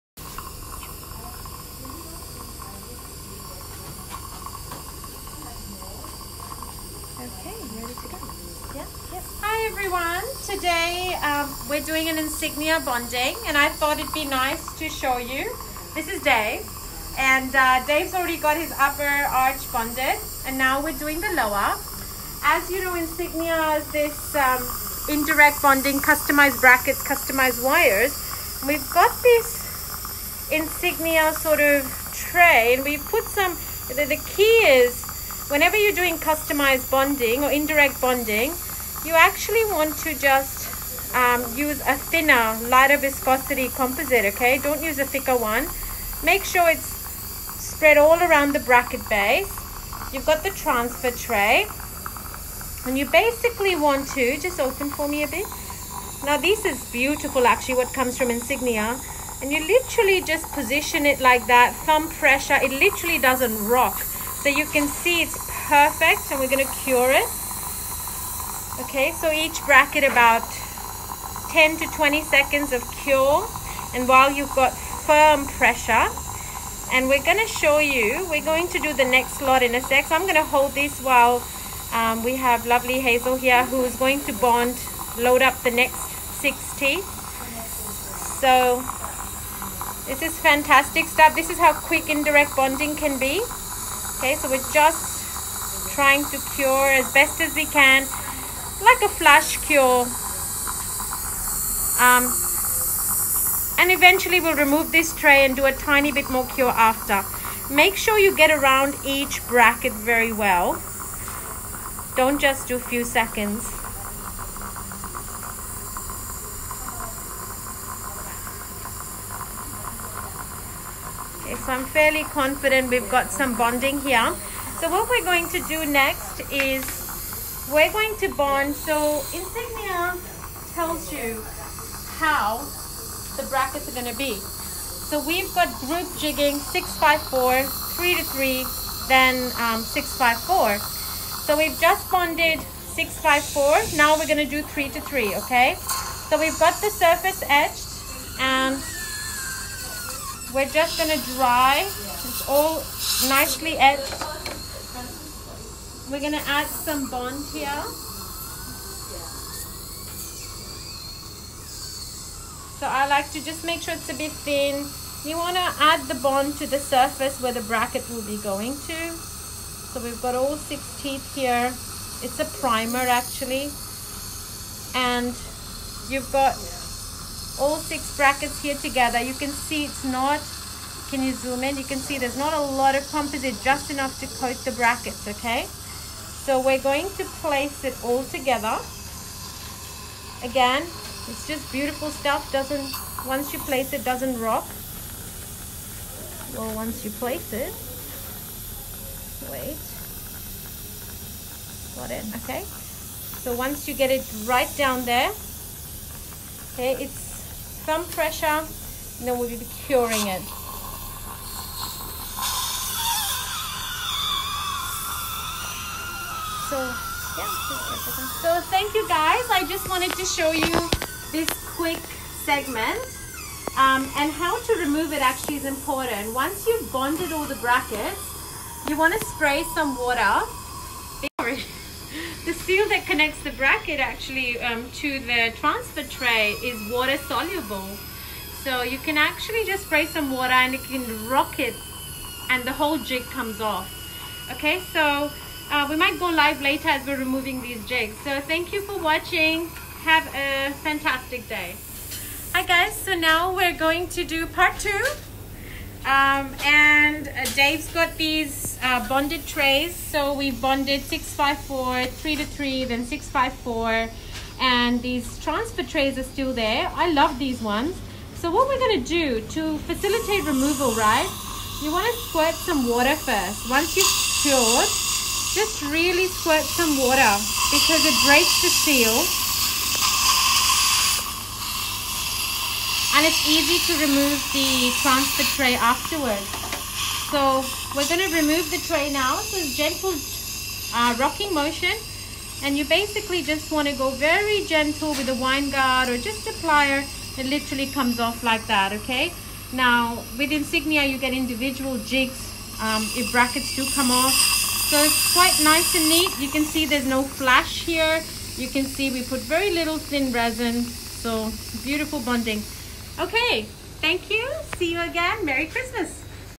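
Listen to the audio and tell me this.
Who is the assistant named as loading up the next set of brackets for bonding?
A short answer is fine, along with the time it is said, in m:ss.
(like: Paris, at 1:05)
Hazel, at 1:22.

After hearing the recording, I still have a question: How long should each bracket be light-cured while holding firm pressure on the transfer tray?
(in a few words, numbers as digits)
10 to 20 seconds.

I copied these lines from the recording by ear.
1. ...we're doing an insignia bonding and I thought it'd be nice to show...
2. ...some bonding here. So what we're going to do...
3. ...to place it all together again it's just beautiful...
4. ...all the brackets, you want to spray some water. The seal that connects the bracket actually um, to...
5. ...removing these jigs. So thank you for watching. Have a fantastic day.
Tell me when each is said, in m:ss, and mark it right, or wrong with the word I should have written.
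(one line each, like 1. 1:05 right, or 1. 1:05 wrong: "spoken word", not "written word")
1. 0:11 right
2. 2:03 right
3. 3:07 right
4. 3:47 right
5. 4:07 right.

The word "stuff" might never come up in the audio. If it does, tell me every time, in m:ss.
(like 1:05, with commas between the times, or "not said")
1:31, 3:12.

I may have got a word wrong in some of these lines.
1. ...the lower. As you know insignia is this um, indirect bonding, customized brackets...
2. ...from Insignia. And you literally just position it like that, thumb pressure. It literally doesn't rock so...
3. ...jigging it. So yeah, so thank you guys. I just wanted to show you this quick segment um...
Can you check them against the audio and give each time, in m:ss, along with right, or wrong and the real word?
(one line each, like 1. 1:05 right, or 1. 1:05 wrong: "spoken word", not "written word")
1. 0:21 right
2. 0:58 right
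3. 3:29 wrong: "curing", not "jigging".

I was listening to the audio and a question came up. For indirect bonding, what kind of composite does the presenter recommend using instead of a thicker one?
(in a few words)
thinner, lighter viscosity composite.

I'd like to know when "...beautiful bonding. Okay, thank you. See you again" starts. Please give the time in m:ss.
5:11.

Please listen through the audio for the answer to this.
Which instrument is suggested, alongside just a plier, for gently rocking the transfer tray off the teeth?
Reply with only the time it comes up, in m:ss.
4:55.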